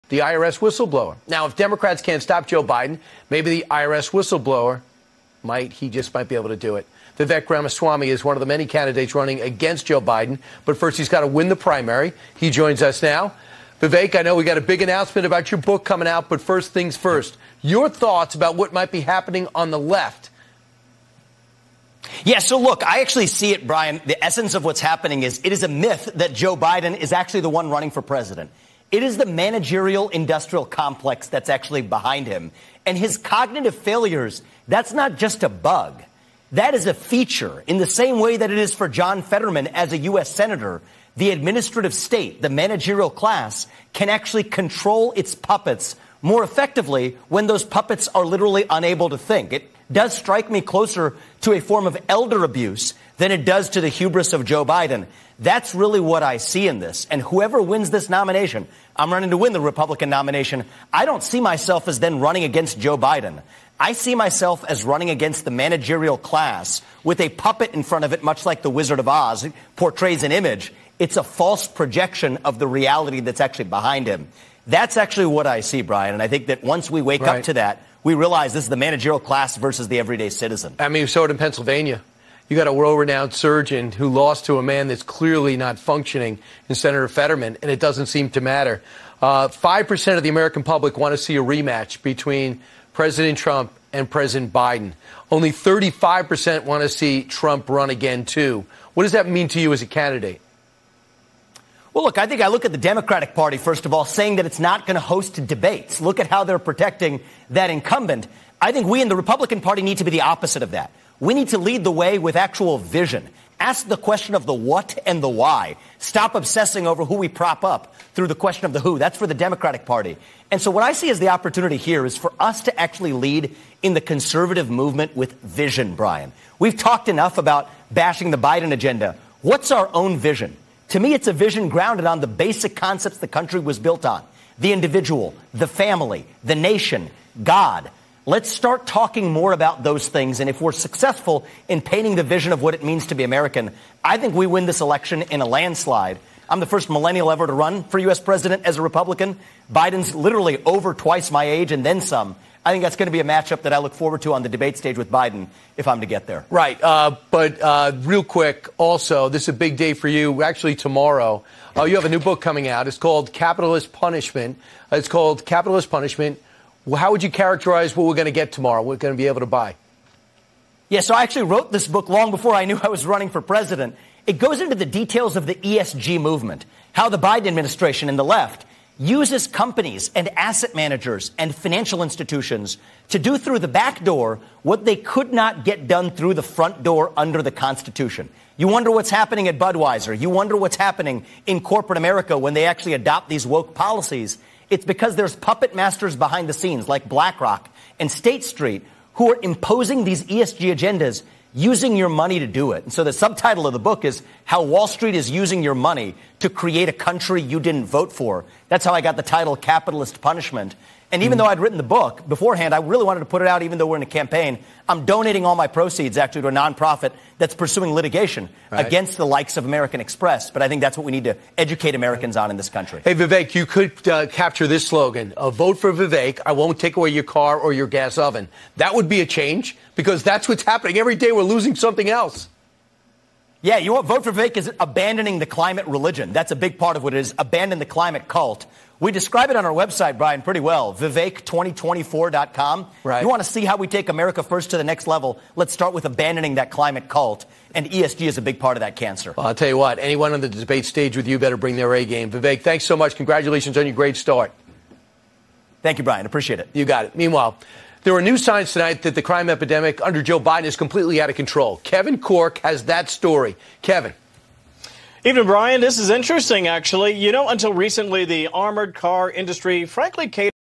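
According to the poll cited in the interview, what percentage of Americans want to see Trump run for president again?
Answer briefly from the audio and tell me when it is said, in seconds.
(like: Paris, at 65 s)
35%, at 95 s.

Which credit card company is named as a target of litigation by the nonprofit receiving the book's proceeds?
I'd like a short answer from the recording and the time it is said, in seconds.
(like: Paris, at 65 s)
American Express, at 219 s.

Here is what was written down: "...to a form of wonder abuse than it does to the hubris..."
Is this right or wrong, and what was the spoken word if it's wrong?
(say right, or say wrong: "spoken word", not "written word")
wrong: "elder", not "wonder".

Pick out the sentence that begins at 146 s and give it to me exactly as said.
I'm the first millennial ever to run for U.S.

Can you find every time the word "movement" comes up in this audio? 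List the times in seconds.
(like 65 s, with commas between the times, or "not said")
124 s, 176 s.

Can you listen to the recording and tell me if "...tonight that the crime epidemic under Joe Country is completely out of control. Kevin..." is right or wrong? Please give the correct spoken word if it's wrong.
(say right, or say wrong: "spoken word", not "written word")
wrong: "Biden", not "Country".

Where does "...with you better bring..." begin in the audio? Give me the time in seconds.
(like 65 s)
251 s.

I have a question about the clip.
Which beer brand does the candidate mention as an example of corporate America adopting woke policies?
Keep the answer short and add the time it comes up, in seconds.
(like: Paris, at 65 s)
Budweiser, at 189 s.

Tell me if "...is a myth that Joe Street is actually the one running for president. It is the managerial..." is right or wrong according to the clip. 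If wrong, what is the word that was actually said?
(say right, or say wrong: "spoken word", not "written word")
wrong: "Biden", not "Street".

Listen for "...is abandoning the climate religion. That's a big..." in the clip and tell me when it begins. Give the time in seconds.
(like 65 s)
234 s.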